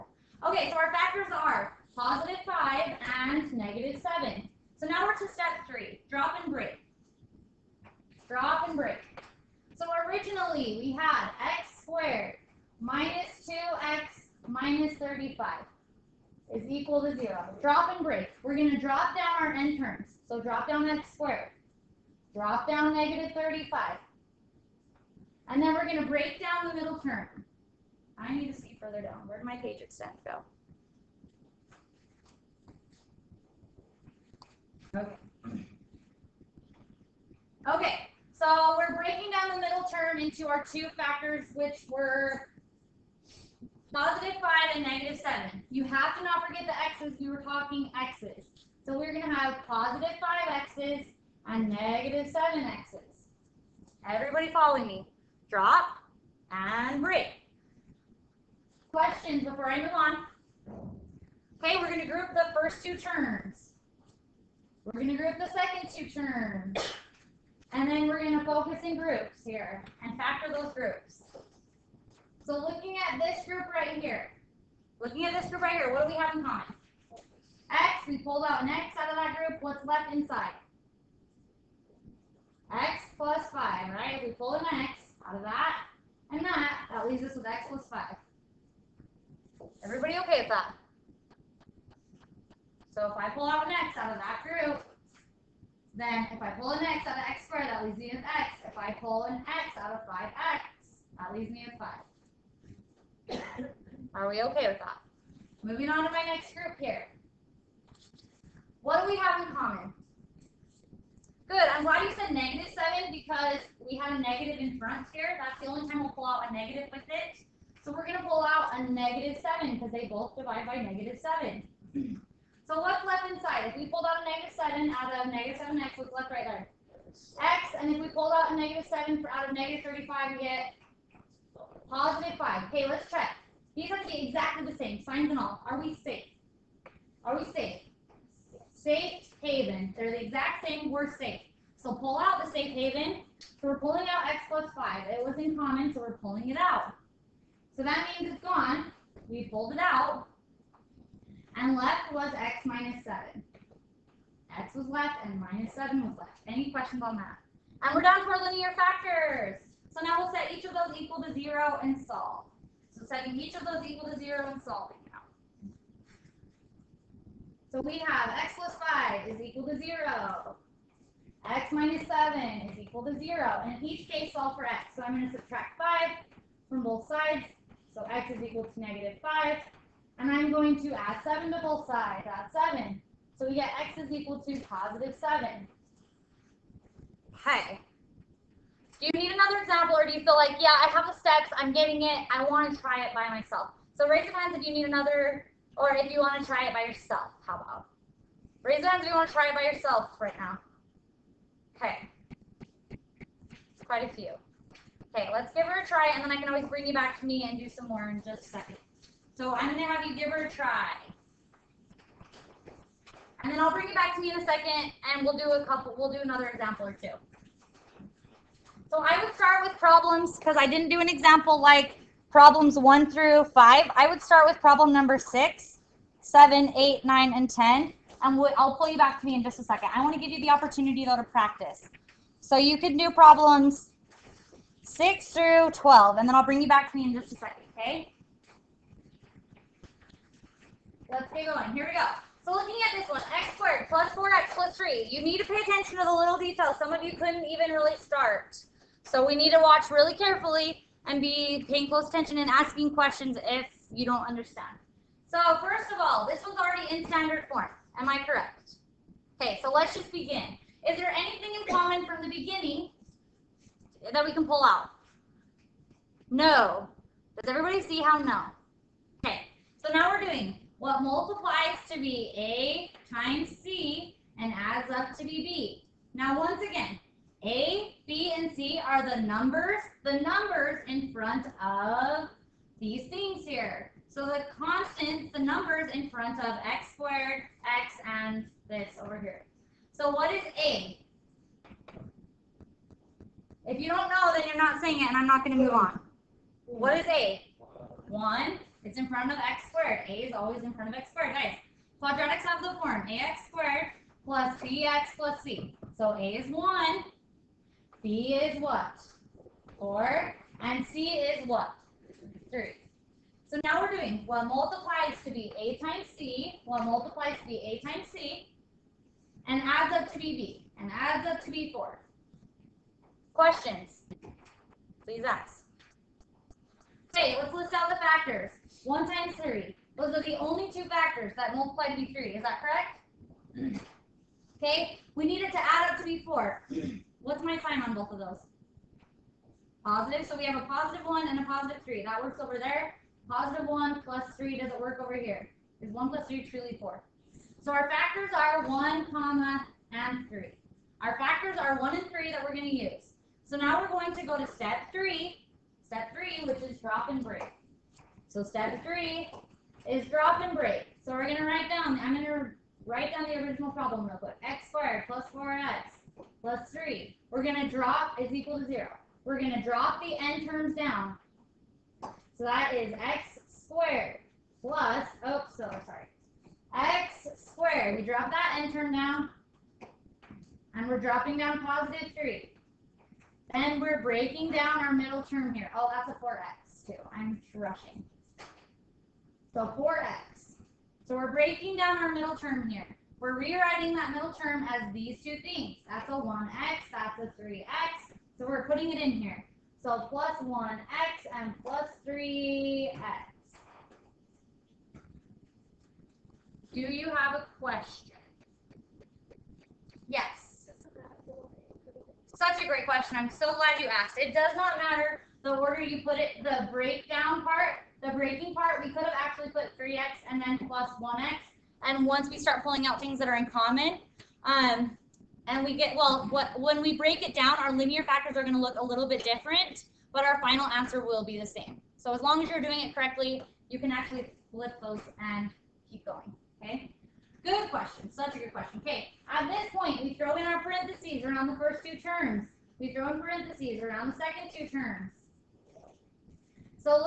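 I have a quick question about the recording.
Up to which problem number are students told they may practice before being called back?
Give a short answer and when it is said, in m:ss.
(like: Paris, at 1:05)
12, at 3:54.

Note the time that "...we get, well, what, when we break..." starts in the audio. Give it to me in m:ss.
7:05.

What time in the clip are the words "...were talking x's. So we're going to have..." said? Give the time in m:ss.
0:47.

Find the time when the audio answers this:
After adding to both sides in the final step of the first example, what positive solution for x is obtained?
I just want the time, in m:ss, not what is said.
3:03.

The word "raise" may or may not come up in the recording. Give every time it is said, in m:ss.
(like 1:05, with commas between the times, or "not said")
3:14, 3:18.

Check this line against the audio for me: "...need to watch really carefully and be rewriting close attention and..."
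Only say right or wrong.
wrong.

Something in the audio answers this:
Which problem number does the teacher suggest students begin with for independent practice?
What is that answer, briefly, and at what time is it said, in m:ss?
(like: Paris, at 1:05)
6, at 3:44.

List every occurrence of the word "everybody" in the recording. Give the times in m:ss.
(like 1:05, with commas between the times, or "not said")
0:54, 1:29, 4:27.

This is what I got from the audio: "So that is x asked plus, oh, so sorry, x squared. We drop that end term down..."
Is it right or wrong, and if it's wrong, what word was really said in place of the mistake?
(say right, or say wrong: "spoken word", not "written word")
wrong: "squared", not "asked".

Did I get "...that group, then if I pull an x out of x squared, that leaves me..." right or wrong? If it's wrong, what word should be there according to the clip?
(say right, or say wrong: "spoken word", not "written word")
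right.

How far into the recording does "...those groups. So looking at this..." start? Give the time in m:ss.
1:10.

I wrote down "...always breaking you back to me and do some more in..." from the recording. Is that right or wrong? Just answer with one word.
wrong.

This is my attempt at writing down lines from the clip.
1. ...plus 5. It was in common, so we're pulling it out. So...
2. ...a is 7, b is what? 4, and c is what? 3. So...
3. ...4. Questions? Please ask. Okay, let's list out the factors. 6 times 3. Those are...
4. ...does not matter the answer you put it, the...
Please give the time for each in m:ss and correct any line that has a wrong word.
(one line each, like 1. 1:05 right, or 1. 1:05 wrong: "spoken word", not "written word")
1. 2:24 right
2. 5:06 wrong: "1", not "7"
3. 5:21 wrong: "1", not "6"
4. 6:54 wrong: "order", not "answer".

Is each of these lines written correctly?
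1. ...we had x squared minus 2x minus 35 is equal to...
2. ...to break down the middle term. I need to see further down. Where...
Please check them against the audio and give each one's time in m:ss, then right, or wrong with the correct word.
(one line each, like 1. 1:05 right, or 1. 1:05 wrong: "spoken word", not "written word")
1. 0:10 right
2. 0:25 right.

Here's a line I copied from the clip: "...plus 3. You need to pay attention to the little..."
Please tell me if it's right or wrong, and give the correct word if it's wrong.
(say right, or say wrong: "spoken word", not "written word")
right.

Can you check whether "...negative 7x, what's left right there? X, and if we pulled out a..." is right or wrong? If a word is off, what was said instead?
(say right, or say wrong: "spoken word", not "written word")
right.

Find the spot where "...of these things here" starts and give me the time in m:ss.
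4:41.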